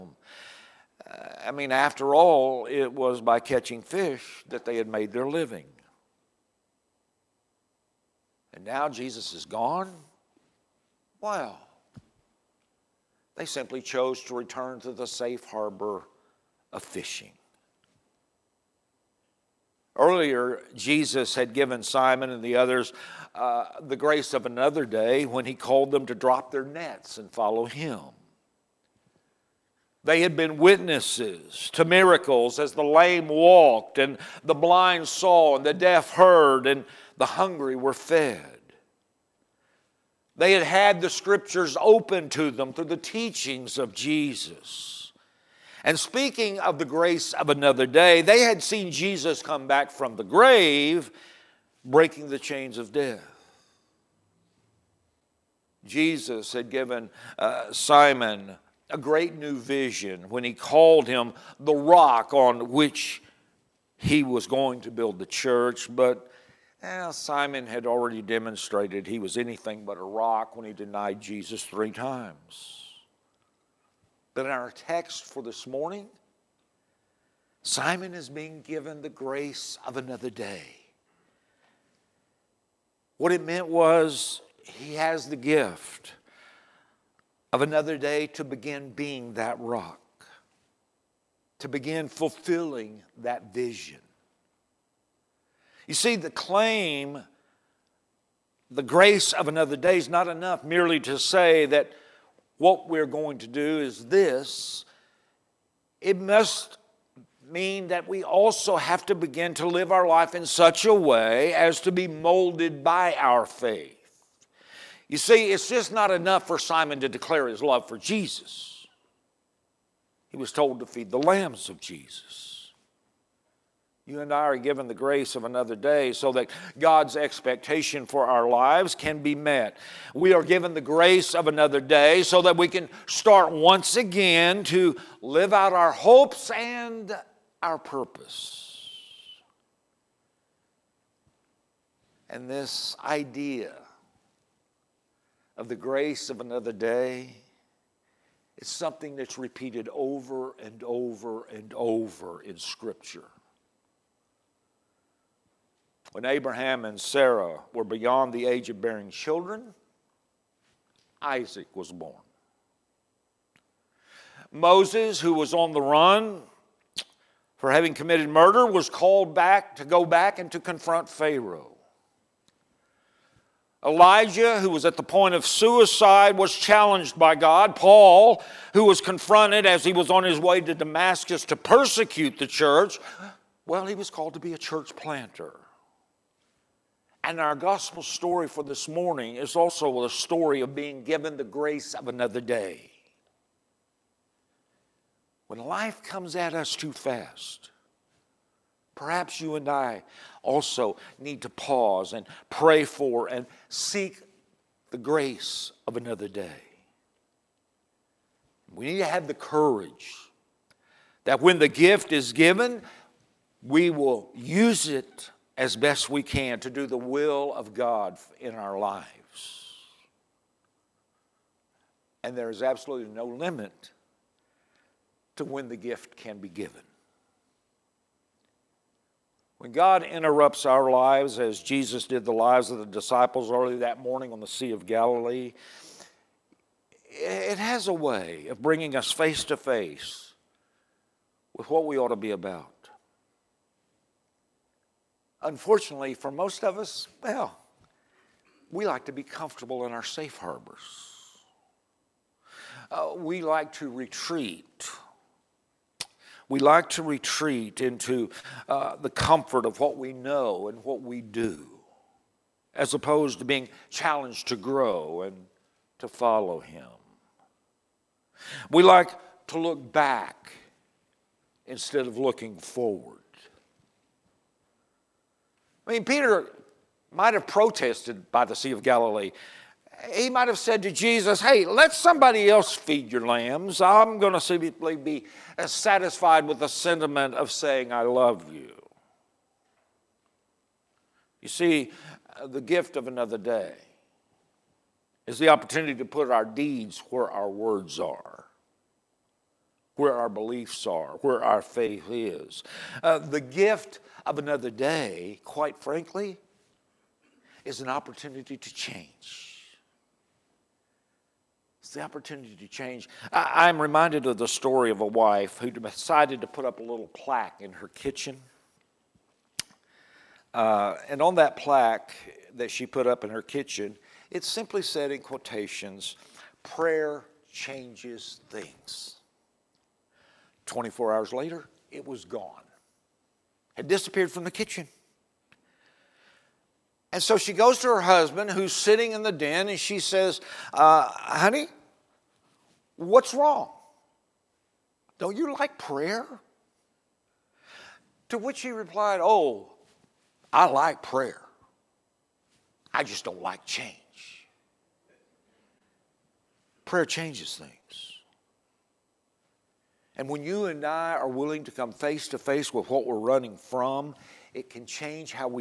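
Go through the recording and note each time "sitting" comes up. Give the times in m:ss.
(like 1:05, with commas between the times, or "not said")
5:38.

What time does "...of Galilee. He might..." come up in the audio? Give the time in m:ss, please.
4:38.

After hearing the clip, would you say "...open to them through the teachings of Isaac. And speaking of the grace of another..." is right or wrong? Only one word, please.
wrong.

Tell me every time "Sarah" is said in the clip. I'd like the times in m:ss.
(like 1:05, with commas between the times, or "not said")
2:36.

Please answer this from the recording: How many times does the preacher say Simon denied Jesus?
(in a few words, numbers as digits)
3.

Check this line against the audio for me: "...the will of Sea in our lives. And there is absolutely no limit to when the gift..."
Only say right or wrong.
wrong.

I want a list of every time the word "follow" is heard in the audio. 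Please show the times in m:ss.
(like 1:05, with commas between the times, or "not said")
0:27, 4:26.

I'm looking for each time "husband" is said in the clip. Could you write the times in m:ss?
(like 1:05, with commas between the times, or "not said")
5:38.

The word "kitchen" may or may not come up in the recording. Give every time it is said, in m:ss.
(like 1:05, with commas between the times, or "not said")
5:17, 5:23, 5:34.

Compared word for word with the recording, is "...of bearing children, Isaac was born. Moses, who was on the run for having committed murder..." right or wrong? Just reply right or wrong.
right.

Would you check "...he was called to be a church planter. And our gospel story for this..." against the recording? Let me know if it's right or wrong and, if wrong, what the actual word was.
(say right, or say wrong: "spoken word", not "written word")
right.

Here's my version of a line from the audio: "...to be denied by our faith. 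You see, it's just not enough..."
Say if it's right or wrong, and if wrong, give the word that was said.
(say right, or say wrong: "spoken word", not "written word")
wrong: "molded", not "denied".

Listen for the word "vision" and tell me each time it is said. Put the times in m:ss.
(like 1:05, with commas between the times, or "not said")
0:59, 1:33.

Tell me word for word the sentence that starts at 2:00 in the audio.
He was told to feed the lambs of Jesus.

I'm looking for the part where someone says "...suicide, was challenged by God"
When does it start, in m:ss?
2:55.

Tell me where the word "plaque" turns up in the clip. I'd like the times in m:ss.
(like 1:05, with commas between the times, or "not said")
5:17, 5:21.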